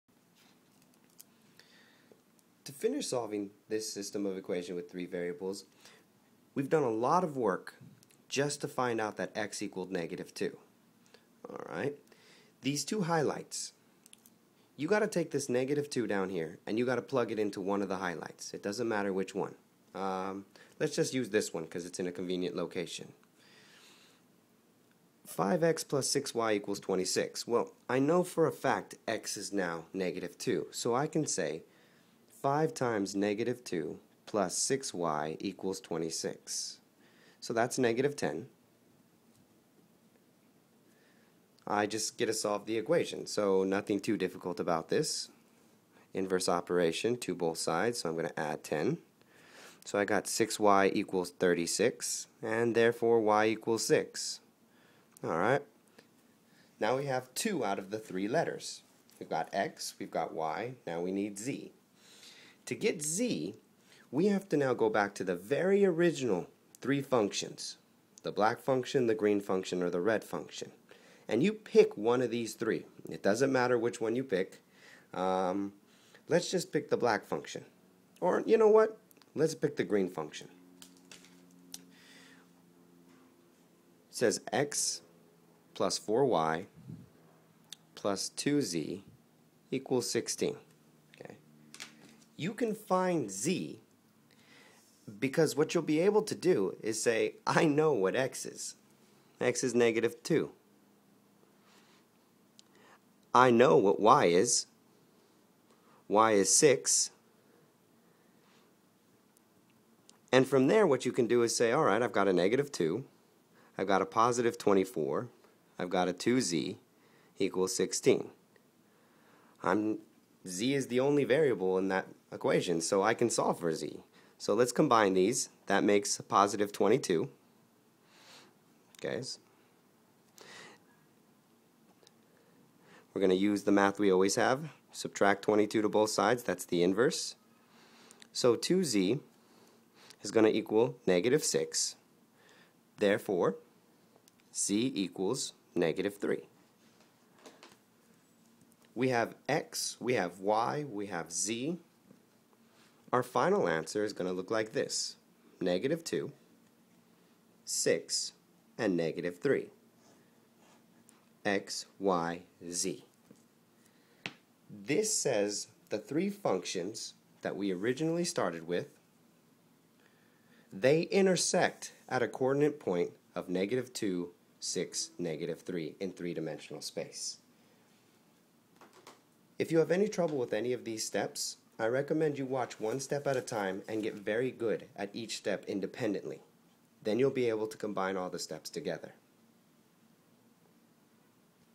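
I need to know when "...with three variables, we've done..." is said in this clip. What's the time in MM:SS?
00:04.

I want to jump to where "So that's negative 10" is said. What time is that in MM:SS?
00:37.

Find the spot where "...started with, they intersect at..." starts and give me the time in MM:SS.
02:48.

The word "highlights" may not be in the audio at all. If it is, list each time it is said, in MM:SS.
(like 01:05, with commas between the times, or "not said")
00:13, 00:17.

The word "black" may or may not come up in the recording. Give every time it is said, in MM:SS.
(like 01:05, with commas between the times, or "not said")
01:08, 01:16.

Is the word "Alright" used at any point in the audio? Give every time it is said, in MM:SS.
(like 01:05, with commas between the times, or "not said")
00:11, 00:55.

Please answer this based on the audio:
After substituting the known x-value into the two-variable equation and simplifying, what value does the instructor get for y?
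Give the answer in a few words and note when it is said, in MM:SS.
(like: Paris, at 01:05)
6, at 00:53.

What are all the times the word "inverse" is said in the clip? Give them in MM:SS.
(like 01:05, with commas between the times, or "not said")
00:46, 02:16.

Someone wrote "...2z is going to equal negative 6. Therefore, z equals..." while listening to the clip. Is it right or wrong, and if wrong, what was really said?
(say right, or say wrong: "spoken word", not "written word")
right.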